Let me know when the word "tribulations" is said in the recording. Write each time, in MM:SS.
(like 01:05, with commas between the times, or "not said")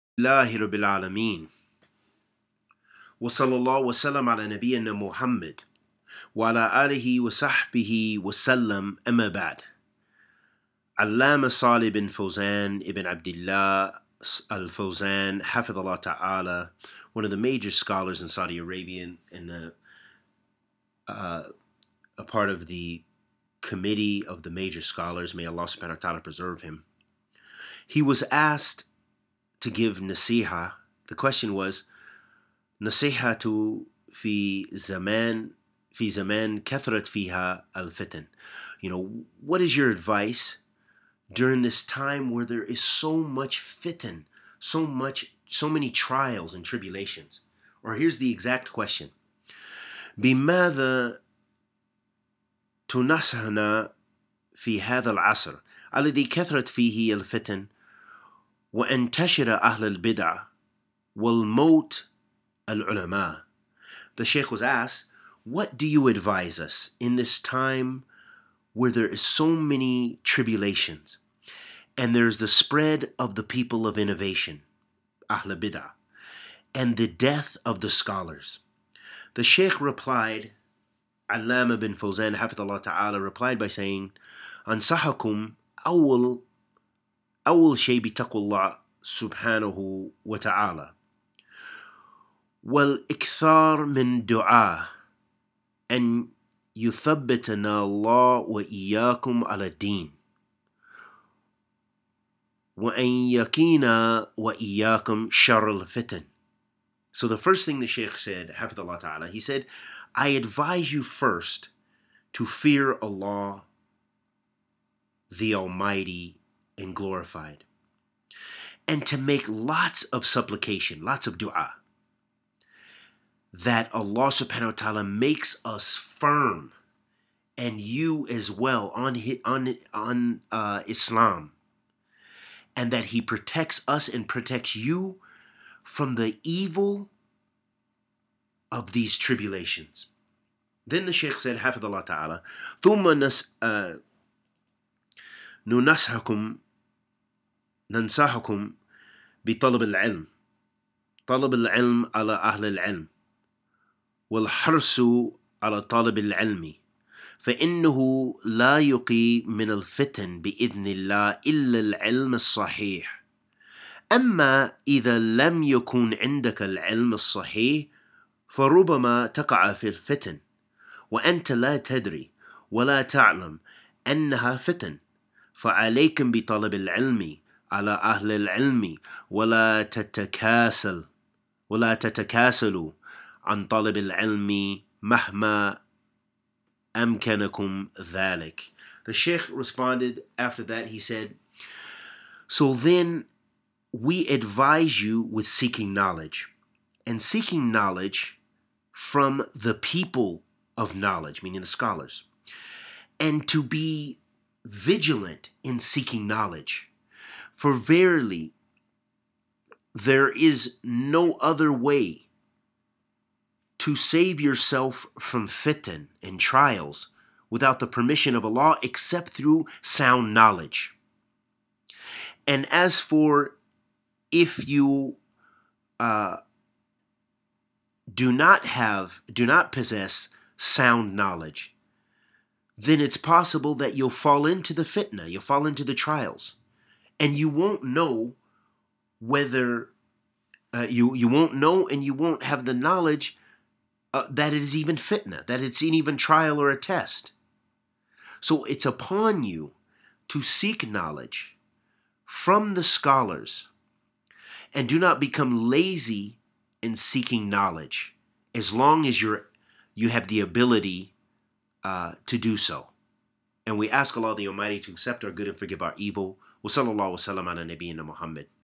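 00:46, 01:10, 02:19.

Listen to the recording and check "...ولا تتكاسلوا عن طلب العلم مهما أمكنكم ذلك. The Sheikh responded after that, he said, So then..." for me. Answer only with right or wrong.
right.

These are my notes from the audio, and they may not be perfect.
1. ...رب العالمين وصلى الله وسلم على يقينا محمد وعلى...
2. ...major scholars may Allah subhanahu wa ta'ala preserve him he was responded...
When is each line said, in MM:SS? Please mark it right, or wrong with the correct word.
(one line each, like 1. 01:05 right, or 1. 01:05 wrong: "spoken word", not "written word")
1. 00:00 wrong: "نبينا", not "يقينا"
2. 00:24 wrong: "asked", not "responded".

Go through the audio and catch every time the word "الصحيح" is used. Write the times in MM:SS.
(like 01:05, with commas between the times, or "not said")
02:42, 02:47.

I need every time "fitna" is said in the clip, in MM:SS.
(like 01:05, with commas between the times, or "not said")
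03:54, 04:04.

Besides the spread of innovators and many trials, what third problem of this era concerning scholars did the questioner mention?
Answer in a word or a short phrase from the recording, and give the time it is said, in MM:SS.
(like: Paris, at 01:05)
the death of the scholars, at 01:16.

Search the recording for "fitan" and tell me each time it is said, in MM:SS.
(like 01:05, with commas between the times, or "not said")
00:37, 00:43, 03:35.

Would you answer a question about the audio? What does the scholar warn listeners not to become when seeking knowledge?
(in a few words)
lazy.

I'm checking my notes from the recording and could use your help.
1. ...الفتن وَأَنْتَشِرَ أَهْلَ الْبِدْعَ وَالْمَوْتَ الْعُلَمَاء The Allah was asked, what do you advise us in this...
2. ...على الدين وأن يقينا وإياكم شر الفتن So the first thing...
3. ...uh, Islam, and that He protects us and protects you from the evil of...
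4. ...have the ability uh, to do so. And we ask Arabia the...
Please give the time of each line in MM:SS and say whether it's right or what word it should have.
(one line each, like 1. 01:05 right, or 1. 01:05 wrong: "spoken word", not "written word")
1. 00:57 wrong: "Sheikh", not "Allah"
2. 01:39 right
3. 02:10 right
4. 04:20 wrong: "Allah", not "Arabia".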